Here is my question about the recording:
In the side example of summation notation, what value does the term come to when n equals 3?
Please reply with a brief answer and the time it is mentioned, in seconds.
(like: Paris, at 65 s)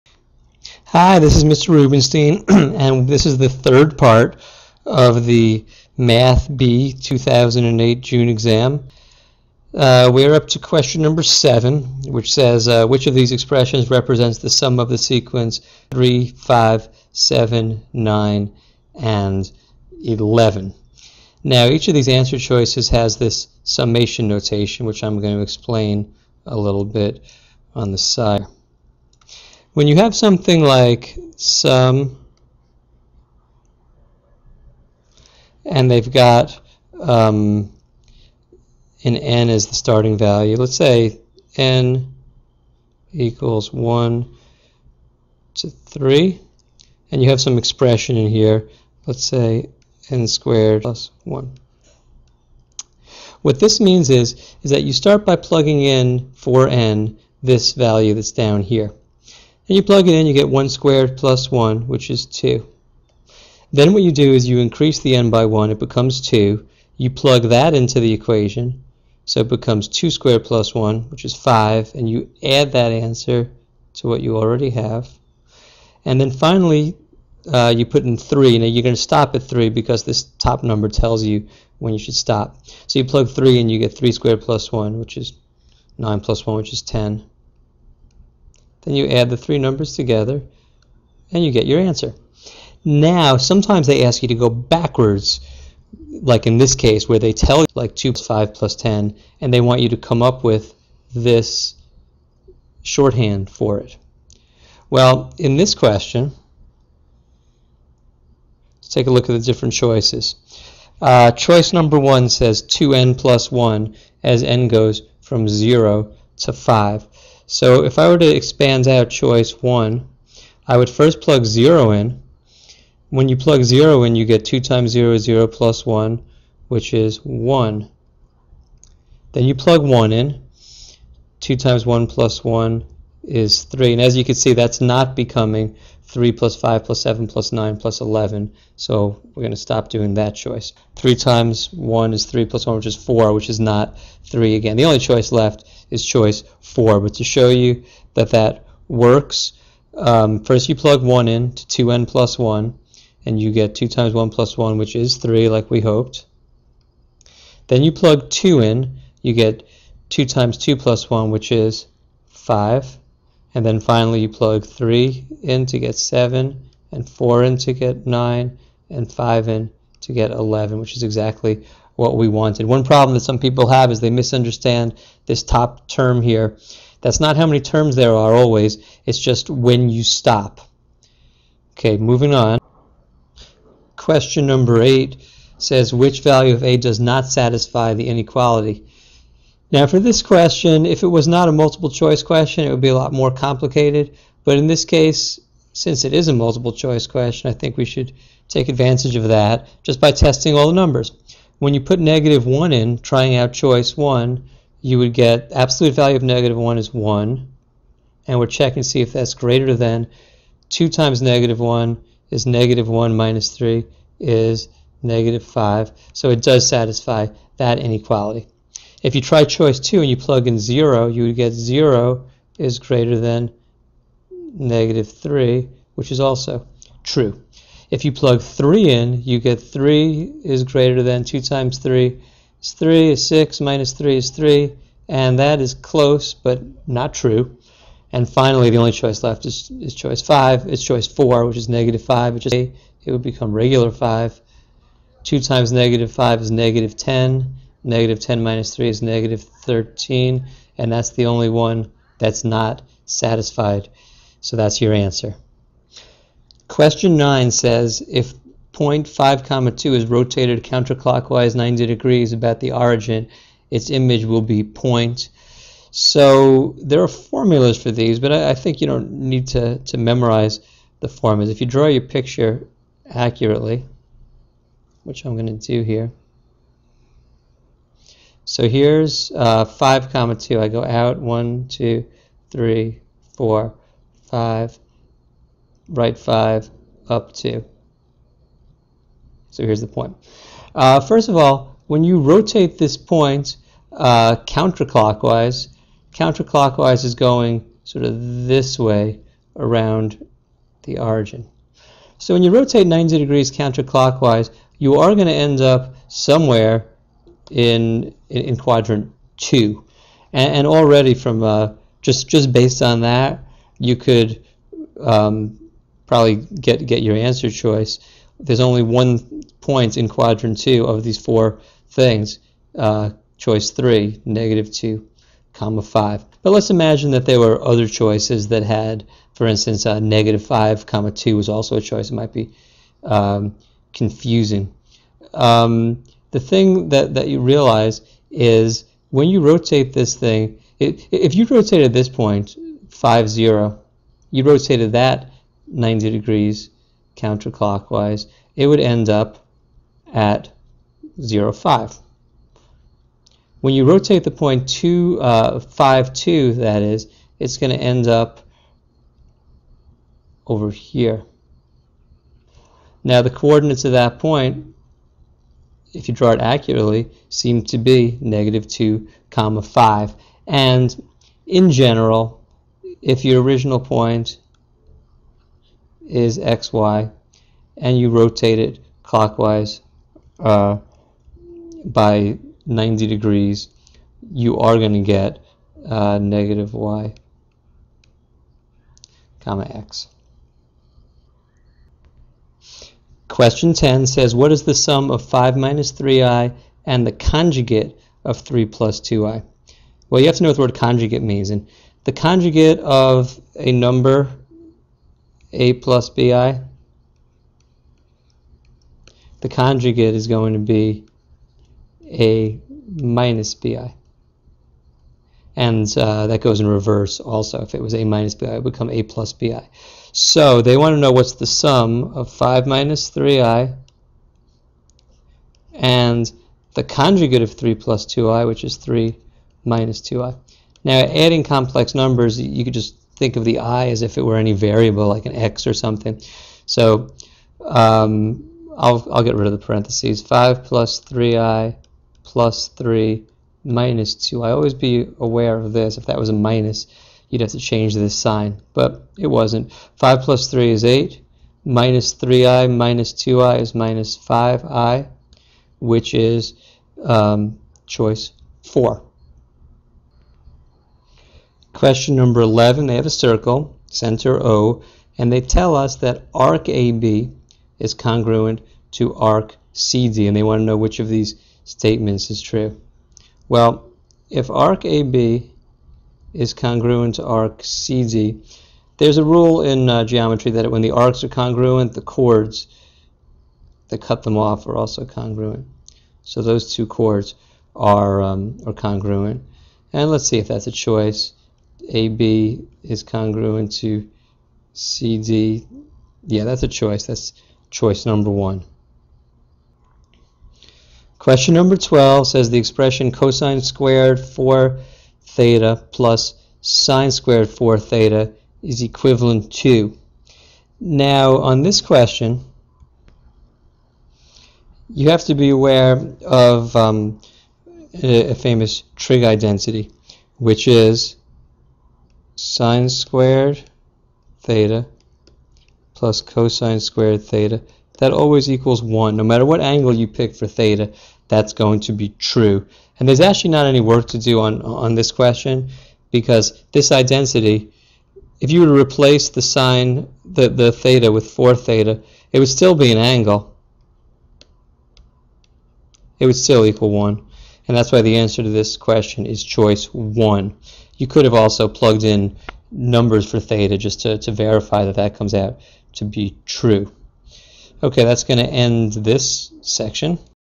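10, at 86 s.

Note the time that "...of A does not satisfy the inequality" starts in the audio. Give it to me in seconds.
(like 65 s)
186 s.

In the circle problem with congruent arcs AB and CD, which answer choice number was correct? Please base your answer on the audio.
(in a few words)
Choice 1.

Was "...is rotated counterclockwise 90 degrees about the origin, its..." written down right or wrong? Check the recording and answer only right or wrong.
right.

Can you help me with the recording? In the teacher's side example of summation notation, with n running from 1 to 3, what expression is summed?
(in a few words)
n squared plus 1.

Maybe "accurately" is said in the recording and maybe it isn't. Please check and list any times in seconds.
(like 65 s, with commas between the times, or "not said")
273 s, 366 s.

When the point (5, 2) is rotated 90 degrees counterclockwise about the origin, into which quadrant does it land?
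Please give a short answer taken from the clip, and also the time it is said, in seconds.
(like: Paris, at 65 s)
Quadrant 2, at 308 s.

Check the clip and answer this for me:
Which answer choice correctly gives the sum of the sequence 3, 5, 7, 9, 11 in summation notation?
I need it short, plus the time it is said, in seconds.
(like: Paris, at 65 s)
Choice 4, at 144 s.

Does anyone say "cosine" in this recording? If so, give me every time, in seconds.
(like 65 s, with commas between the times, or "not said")
503 s, 526 s.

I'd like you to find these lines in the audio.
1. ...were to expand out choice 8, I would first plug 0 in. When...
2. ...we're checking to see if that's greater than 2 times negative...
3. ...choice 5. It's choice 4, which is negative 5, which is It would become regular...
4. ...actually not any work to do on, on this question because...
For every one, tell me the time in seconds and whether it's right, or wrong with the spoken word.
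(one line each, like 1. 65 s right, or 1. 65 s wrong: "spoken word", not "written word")
1. 118 s wrong: "1", not "8"
2. 208 s right
3. 239 s right
4. 533 s right.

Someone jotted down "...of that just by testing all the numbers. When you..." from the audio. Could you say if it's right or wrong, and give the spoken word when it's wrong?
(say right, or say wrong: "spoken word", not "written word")
right.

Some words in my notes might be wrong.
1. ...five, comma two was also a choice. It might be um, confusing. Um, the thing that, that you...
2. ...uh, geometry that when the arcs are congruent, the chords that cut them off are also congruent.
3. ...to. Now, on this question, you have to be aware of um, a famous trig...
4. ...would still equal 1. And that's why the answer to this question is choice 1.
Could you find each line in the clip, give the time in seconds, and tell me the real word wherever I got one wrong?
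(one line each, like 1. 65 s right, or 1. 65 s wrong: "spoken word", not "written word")
1. 330 s right
2. 479 s right
3. 509 s right
4. 546 s right.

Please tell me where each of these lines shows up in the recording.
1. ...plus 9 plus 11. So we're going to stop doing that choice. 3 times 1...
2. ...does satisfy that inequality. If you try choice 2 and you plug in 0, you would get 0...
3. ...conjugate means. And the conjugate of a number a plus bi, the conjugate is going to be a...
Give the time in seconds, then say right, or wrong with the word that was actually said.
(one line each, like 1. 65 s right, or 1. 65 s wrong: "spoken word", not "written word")
1. 137 s right
2. 216 s right
3. 400 s right.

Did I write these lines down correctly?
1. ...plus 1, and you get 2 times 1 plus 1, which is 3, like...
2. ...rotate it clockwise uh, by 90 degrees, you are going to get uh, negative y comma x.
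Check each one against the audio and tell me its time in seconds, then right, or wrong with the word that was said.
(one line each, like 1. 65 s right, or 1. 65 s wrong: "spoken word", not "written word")
1. 152 s right
2. 378 s right.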